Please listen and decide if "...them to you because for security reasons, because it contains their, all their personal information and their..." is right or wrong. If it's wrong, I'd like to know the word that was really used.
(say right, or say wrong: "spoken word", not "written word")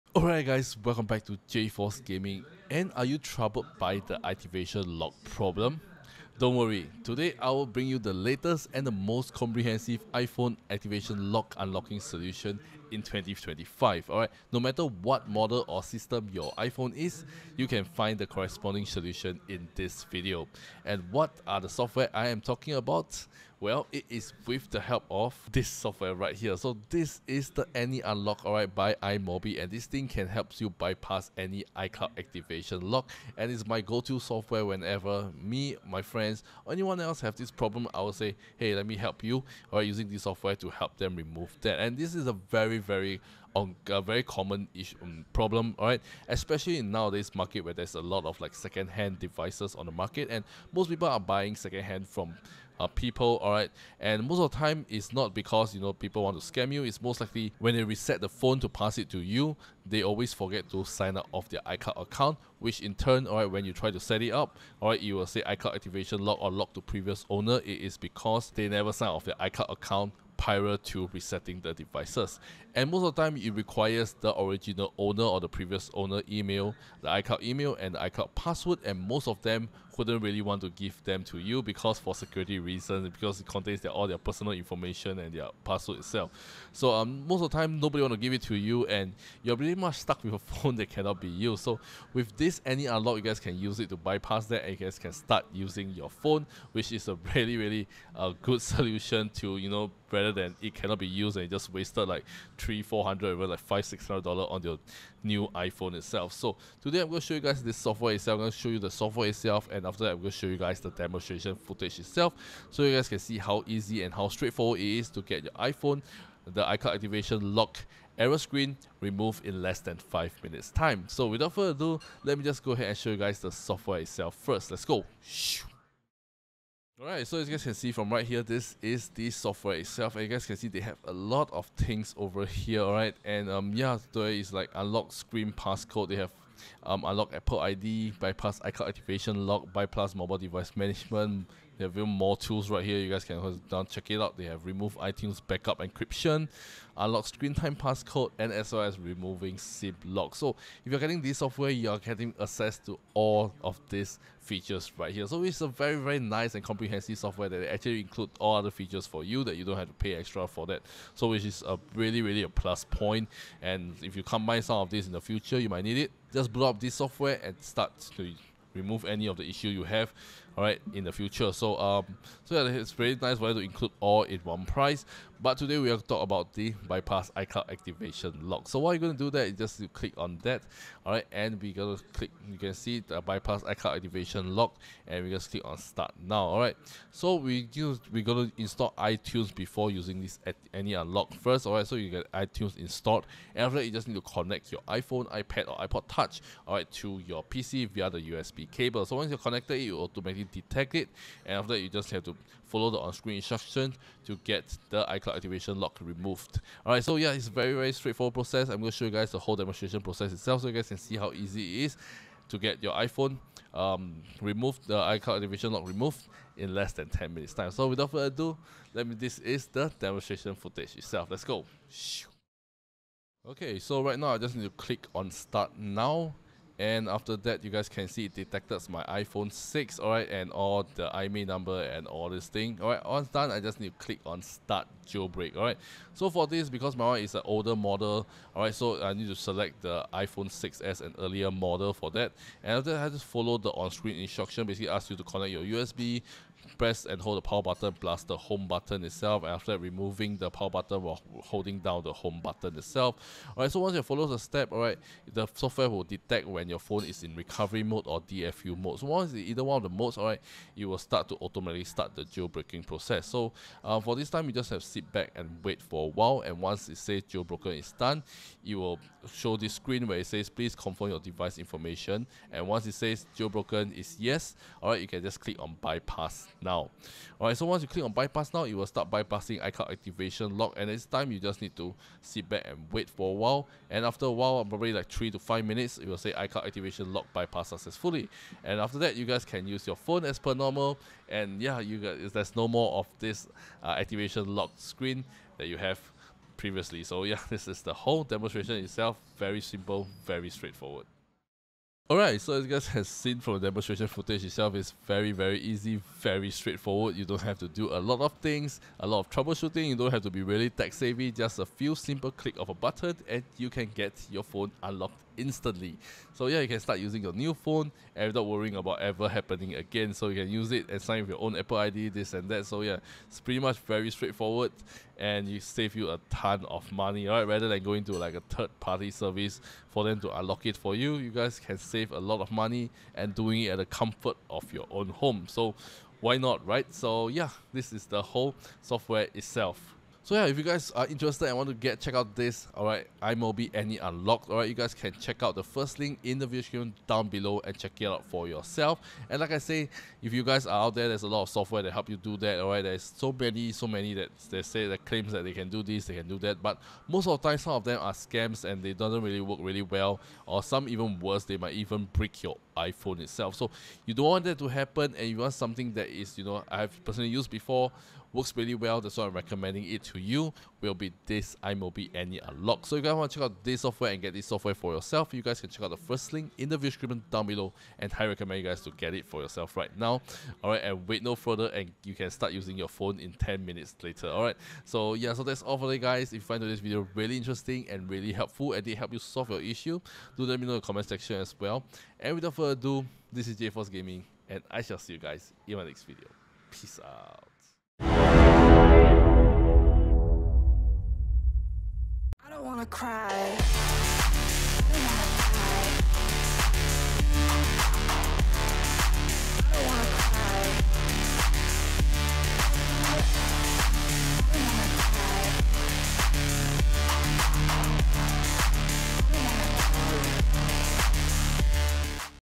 right.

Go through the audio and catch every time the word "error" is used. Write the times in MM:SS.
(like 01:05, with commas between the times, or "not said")
01:58.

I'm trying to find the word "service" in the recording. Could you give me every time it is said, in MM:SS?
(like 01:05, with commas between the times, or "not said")
05:29.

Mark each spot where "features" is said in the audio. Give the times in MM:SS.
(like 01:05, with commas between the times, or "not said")
02:34, 02:38.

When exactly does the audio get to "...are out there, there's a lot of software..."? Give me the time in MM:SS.
05:50.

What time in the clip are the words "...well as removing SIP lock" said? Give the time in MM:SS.
02:28.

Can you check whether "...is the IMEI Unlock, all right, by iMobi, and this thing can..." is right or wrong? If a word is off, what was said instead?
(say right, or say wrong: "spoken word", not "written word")
wrong: "Any", not "IMEI".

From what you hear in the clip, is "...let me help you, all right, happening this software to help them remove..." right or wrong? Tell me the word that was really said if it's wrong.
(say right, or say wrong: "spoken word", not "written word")
wrong: "using", not "happening".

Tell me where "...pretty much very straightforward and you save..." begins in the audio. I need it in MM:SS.
05:23.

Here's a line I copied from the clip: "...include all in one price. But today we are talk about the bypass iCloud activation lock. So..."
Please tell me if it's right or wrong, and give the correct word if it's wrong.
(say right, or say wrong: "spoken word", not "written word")
right.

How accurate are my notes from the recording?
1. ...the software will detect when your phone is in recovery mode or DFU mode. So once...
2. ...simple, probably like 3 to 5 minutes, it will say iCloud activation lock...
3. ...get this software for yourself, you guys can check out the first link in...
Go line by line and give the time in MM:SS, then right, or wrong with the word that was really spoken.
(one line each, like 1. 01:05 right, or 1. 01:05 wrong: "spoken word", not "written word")
1. 04:15 right
2. 04:44 wrong: "while", not "simple"
3. 06:14 right.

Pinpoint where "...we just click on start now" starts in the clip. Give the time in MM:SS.
03:05.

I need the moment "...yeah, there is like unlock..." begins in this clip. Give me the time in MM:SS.
02:13.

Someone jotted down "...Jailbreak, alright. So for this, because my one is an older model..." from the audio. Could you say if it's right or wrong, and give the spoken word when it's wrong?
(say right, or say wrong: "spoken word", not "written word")
right.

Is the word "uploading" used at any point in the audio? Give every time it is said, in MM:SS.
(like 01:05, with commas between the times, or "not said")
not said.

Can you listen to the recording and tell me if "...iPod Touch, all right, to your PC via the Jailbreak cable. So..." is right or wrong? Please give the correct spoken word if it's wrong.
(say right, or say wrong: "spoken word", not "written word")
wrong: "USB", not "Jailbreak".